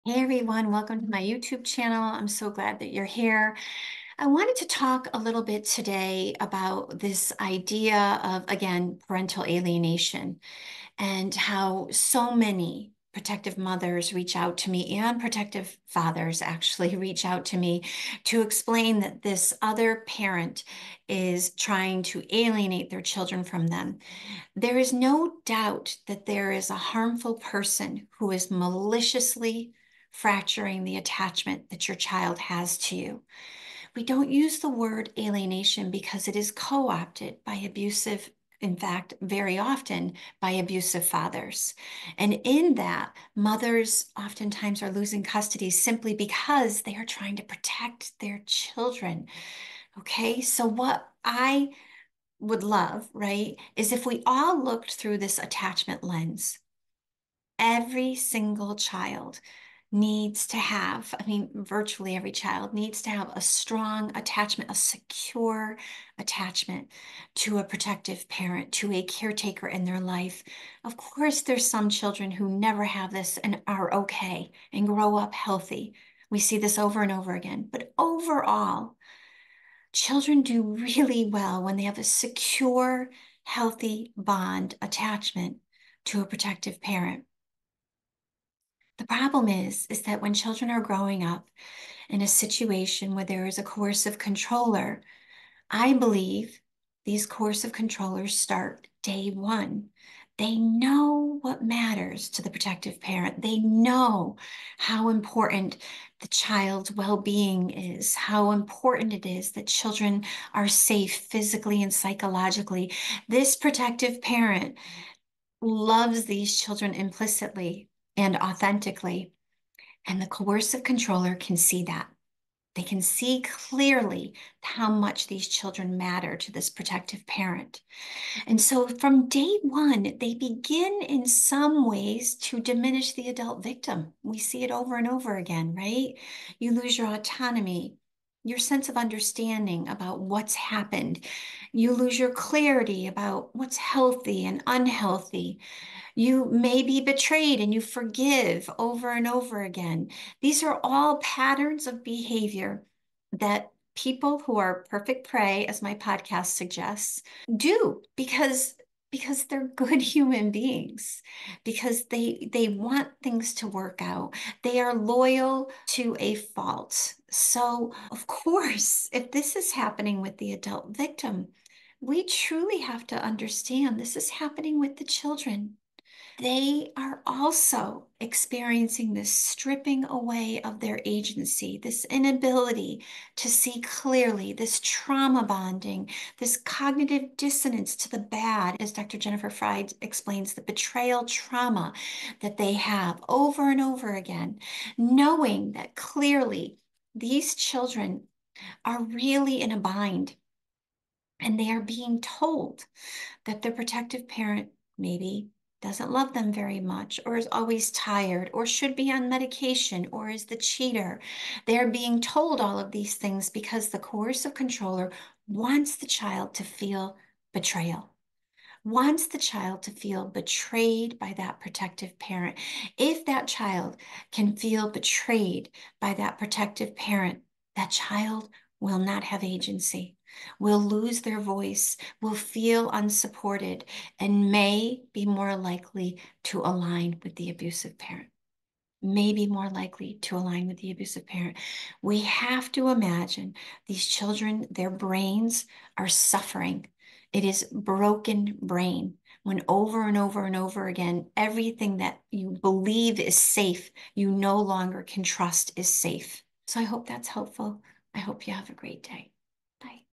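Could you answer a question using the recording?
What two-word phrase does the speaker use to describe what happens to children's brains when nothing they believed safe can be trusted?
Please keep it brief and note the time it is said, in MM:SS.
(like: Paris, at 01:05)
broken brain, at 04:07.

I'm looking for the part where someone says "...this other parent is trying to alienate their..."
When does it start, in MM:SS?
00:19.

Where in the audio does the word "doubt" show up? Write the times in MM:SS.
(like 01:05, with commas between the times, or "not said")
00:25.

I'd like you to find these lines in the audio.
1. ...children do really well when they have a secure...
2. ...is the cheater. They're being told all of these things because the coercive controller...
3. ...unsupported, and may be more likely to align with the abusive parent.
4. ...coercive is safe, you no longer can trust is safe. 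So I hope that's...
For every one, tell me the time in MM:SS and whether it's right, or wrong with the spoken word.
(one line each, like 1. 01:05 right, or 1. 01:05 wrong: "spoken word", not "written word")
1. 01:19 right
2. 03:30 right
3. 03:52 right
4. 04:12 wrong: "believe", not "coercive".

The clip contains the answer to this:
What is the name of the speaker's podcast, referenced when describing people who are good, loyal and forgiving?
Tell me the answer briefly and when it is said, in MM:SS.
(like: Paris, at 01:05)
Perfect Prey, at 02:34.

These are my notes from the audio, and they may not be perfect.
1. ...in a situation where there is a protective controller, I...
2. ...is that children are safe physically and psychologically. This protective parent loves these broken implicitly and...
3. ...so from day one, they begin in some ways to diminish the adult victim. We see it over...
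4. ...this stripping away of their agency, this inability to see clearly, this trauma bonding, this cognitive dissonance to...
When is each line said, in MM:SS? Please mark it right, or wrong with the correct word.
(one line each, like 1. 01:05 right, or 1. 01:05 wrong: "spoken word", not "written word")
1. 01:32 wrong: "coercive", not "protective"
2. 01:49 wrong: "children", not "broken"
3. 02:08 right
4. 02:59 right.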